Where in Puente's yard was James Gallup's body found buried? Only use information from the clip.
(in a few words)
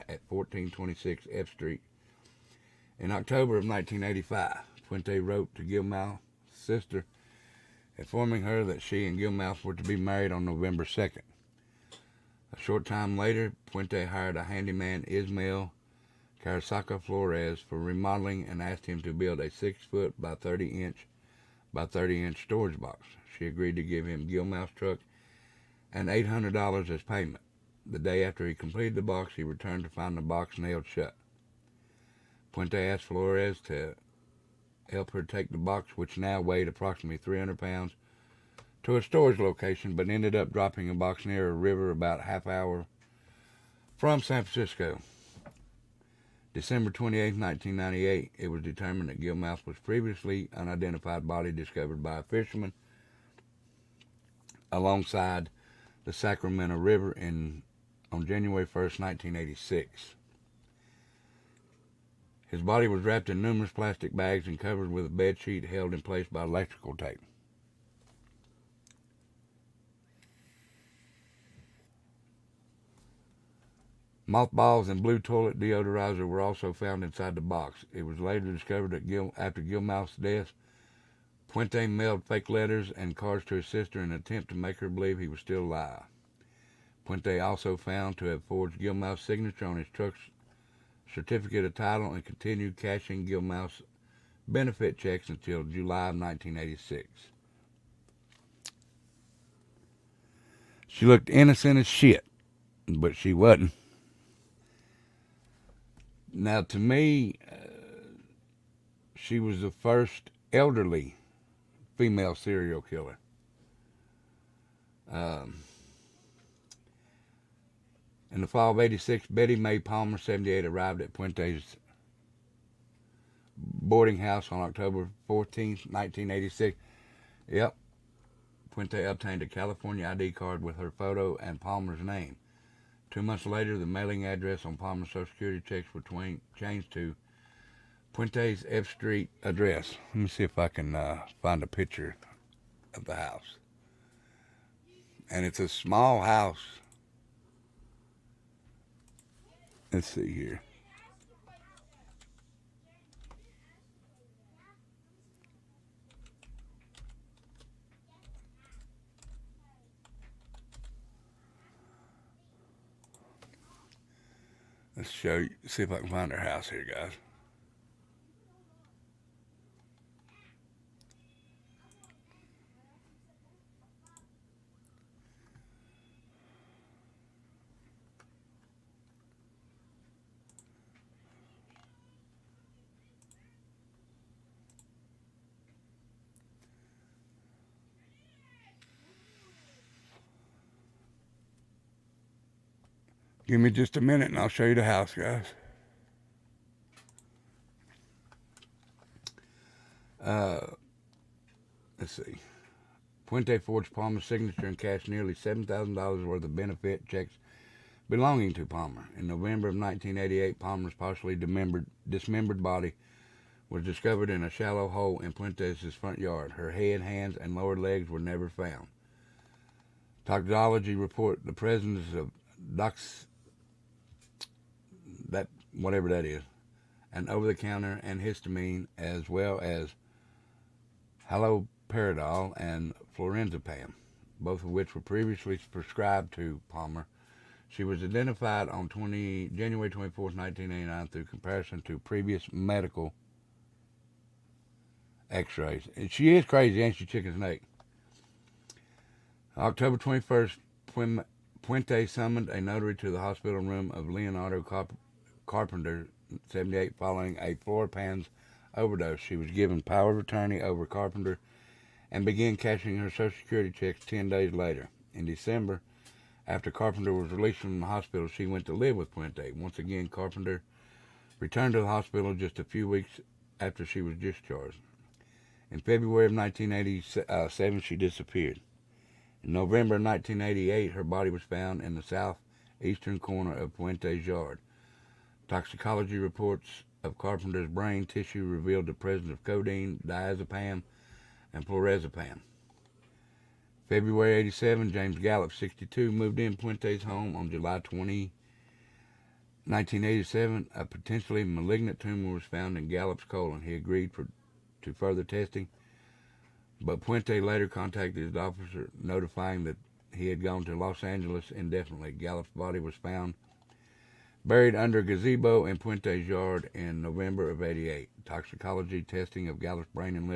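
under gazebo.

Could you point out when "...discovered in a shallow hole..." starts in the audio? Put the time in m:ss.
3:33.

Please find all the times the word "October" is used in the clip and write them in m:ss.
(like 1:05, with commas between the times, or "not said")
0:03, 2:04, 4:09.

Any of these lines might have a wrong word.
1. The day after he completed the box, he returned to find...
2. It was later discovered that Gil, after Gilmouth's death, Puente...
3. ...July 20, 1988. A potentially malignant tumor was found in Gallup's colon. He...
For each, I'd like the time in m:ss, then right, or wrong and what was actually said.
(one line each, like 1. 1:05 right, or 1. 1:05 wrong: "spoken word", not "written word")
1. 0:27 right
2. 1:17 right
3. 4:57 wrong: "1987", not "1988".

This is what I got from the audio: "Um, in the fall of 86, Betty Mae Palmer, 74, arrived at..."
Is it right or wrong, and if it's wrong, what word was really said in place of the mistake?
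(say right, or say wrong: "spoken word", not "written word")
wrong: "78", not "74".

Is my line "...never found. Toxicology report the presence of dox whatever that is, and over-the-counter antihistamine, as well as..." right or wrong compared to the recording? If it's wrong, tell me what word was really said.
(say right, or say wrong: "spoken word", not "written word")
right.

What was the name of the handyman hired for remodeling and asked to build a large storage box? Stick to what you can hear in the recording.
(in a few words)
Ismael Carasaca Flores.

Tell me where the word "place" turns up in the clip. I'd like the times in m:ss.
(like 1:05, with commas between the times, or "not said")
1:06.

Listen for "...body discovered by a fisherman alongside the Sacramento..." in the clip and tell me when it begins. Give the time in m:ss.
0:51.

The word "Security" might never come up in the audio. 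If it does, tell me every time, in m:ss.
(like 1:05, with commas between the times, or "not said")
2:15, 4:23.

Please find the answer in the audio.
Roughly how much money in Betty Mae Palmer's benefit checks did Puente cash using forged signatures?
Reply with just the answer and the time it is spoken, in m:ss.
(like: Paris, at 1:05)
$7,000, at 3:25.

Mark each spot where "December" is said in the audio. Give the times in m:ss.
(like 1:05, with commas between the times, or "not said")
0:46, 4:25.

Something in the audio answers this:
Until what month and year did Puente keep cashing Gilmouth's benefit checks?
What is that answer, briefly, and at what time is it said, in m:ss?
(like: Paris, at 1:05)
July 1986, at 1:35.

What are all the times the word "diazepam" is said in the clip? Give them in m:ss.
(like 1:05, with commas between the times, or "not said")
4:50.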